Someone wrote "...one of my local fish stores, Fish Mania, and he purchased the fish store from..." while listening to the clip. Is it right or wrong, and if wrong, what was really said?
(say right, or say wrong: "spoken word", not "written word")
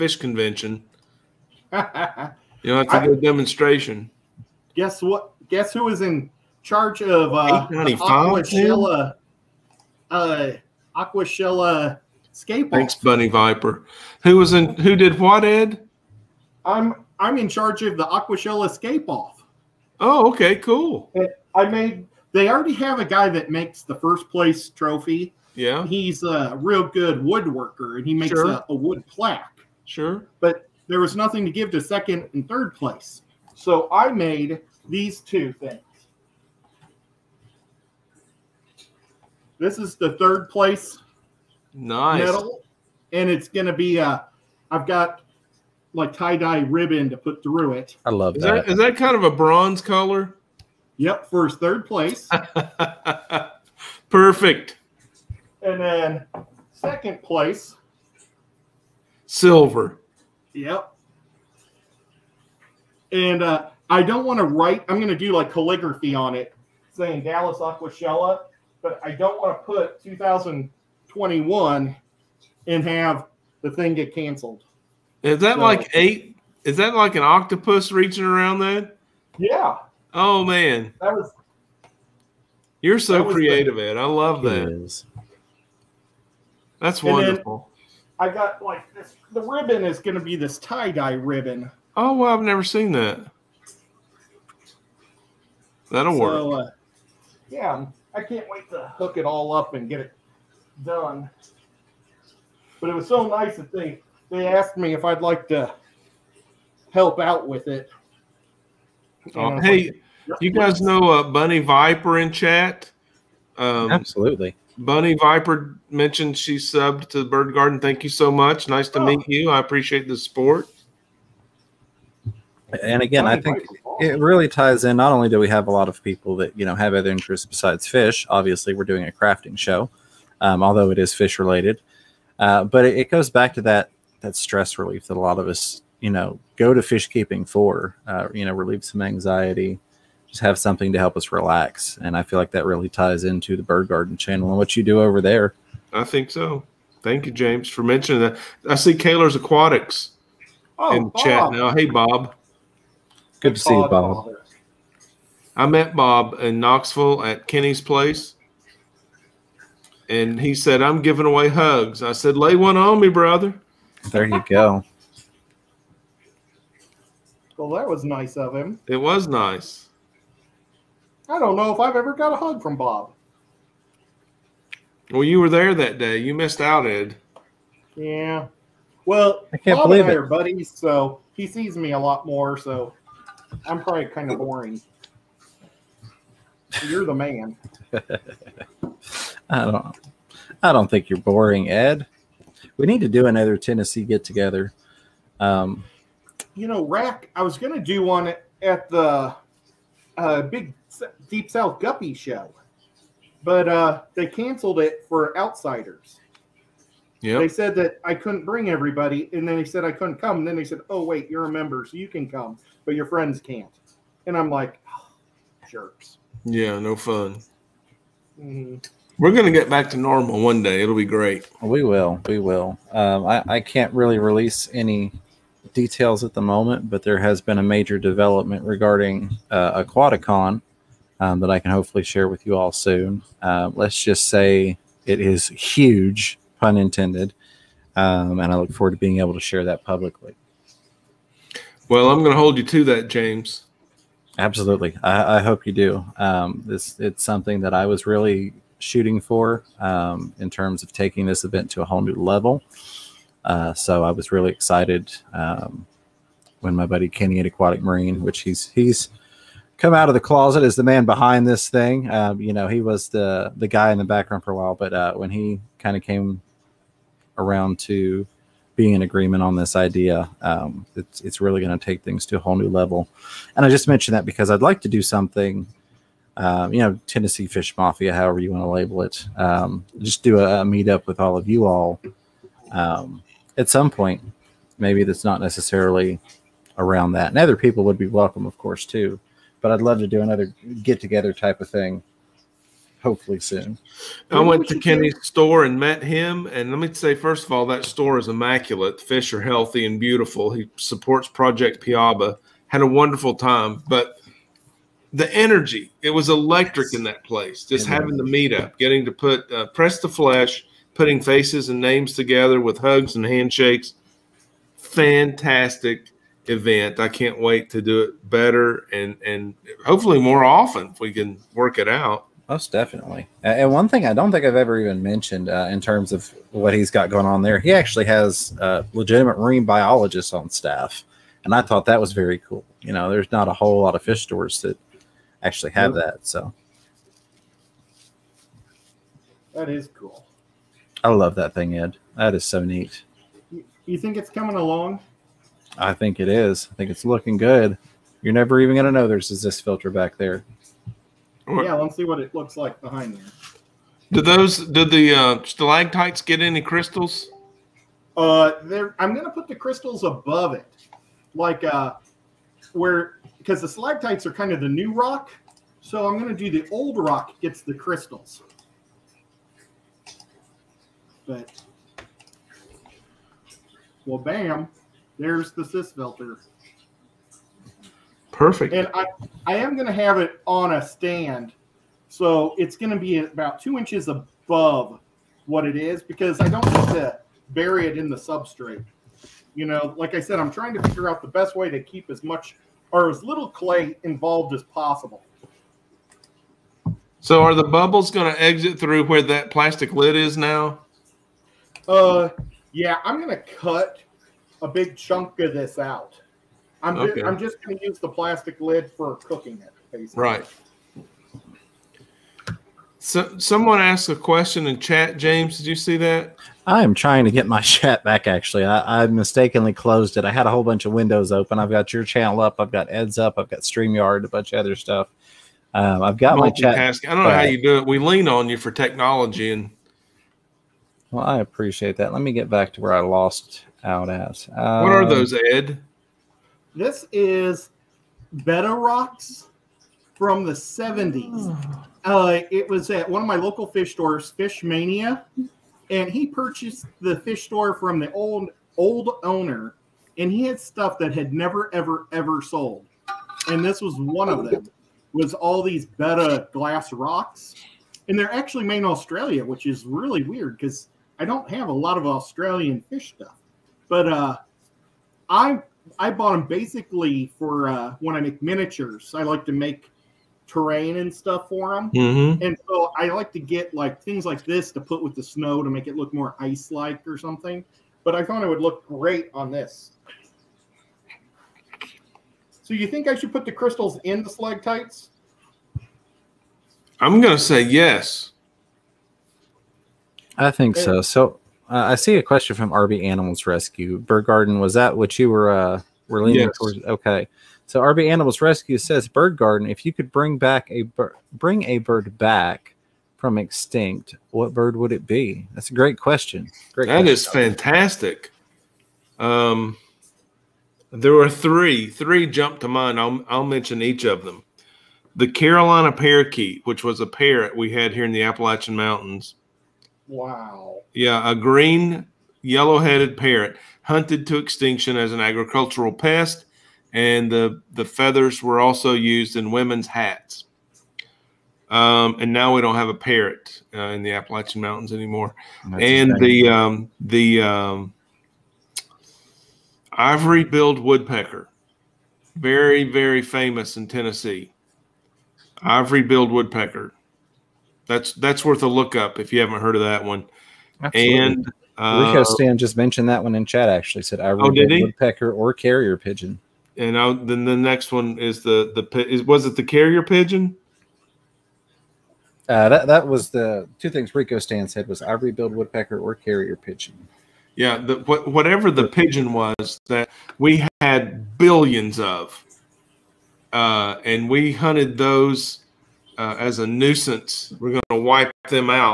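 right.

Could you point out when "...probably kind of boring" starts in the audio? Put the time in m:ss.
3:03.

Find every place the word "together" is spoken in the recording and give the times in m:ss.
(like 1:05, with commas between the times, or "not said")
3:14, 4:51, 5:12.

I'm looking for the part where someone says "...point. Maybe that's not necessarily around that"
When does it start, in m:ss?
4:43.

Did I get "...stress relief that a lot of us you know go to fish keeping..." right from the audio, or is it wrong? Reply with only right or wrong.
right.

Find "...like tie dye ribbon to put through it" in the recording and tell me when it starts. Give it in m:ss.
0:45.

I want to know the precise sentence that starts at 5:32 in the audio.
You know, there's not a whole lot of fish stores that actually have that, so that is cool.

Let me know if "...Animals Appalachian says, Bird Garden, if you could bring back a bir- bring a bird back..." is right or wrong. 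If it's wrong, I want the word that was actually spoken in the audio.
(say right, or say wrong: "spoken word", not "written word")
wrong: "Rescue", not "Appalachian".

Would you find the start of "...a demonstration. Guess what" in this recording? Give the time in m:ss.
0:03.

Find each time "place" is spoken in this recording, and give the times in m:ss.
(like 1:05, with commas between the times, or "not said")
0:24, 0:32, 0:40, 0:51, 0:57, 2:37, 5:07.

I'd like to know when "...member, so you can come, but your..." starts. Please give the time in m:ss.
3:31.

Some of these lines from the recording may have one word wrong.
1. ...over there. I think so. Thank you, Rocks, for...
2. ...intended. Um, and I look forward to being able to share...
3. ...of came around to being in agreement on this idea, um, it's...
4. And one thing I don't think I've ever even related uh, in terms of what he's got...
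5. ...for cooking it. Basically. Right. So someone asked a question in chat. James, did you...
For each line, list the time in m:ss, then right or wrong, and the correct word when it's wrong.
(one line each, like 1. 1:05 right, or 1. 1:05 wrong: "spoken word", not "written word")
1. 2:25 wrong: "James", not "Rocks"
2. 3:56 right
3. 4:25 right
4. 5:23 wrong: "mentioned", not "related"
5. 6:48 right.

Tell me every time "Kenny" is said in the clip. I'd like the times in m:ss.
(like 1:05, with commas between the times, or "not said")
2:37, 4:17, 4:54.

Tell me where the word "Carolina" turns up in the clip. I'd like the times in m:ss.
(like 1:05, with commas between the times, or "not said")
8:35.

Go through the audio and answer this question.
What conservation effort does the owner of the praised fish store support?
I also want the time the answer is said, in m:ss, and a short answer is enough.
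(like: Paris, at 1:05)
Project Piaba, at 5:01.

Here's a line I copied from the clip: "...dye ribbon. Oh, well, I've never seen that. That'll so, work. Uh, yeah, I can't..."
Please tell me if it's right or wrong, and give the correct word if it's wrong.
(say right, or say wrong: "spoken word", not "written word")
right.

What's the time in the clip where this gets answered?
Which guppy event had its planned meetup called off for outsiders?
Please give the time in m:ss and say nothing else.
3:21.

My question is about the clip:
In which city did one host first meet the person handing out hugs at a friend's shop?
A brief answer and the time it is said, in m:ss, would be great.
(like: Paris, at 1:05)
Knoxville, at 2:36.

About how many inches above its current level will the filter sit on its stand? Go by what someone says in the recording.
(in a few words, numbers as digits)
2.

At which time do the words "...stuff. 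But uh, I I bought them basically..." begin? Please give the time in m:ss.
7:43.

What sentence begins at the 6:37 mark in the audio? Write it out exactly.
So are the bubbles going to exit through where that plastic lid is now?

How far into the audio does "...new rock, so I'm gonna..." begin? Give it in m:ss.
6:04.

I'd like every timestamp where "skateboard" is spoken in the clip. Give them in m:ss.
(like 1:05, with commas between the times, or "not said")
0:12.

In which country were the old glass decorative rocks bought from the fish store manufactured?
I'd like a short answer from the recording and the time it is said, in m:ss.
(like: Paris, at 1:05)
Australia, at 7:38.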